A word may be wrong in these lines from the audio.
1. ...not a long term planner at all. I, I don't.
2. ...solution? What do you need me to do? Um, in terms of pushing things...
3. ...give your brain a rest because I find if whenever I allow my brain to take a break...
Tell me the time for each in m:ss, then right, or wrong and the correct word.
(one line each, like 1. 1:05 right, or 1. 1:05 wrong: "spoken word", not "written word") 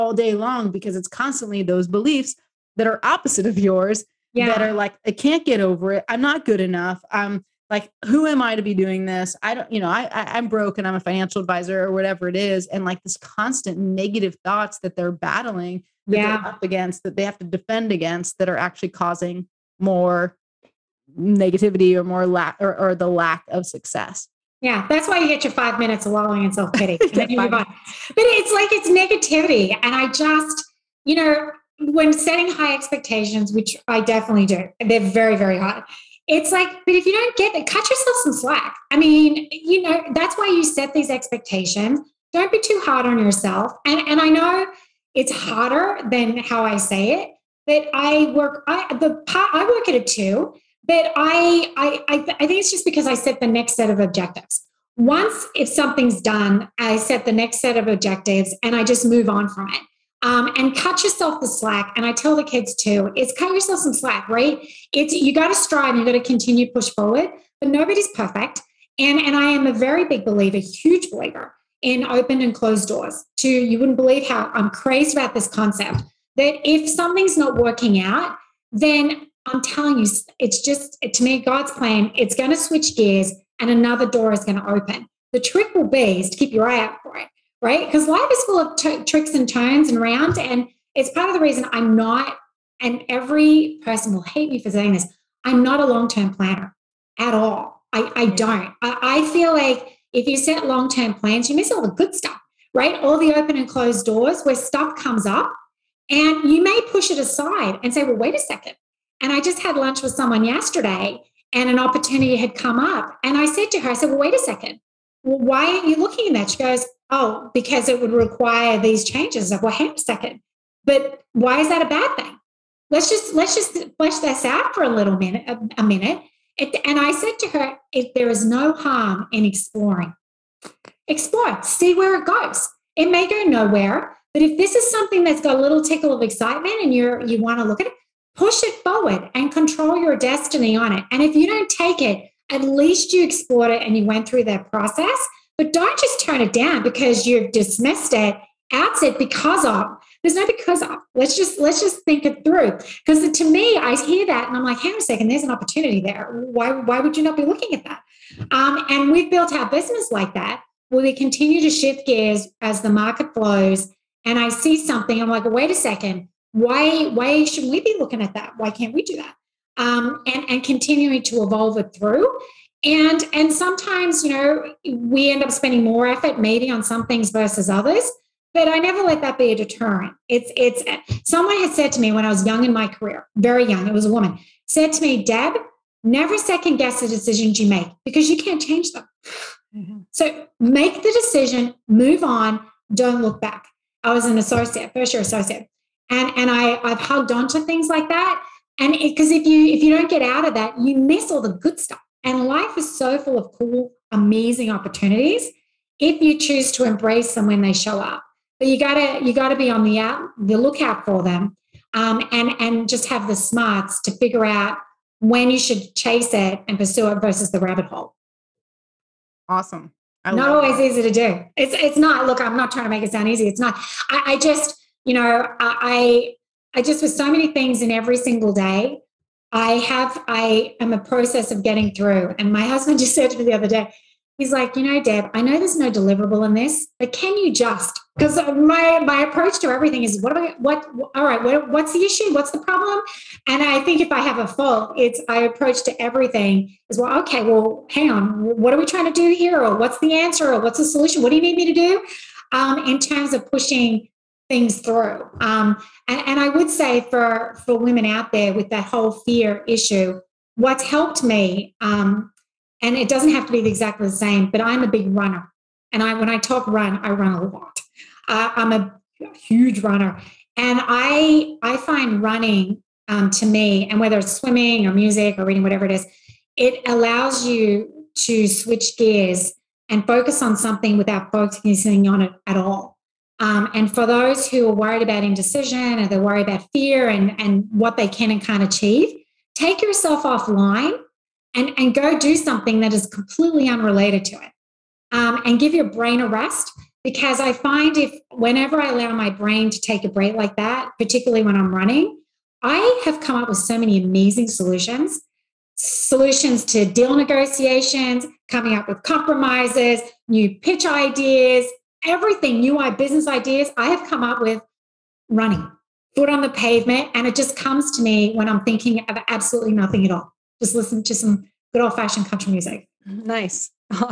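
1. 1:35 right
2. 4:10 right
3. 4:55 right.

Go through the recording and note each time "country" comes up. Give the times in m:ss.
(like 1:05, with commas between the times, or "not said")
5:22.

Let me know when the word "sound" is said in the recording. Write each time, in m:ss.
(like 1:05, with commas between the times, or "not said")
3:43.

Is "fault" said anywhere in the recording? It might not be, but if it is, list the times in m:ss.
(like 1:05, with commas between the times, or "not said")
4:04.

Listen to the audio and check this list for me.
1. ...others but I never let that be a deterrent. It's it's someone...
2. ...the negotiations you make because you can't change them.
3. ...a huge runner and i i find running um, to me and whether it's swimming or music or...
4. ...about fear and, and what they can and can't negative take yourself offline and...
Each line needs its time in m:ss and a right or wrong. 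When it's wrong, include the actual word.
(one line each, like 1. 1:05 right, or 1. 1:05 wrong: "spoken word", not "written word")
1. 2:57 right
2. 3:06 wrong: "decisions", not "negotiations"
3. 4:28 right
4. 4:46 wrong: "achieve", not "negative".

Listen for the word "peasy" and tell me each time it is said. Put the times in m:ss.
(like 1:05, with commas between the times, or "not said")
not said.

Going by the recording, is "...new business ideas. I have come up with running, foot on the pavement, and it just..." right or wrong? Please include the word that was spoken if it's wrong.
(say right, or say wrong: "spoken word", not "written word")
right.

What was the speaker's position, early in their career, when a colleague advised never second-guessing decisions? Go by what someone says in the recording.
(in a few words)
First year associate.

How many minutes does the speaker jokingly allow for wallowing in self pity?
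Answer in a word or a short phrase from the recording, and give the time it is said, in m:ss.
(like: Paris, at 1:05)
5, at 0:25.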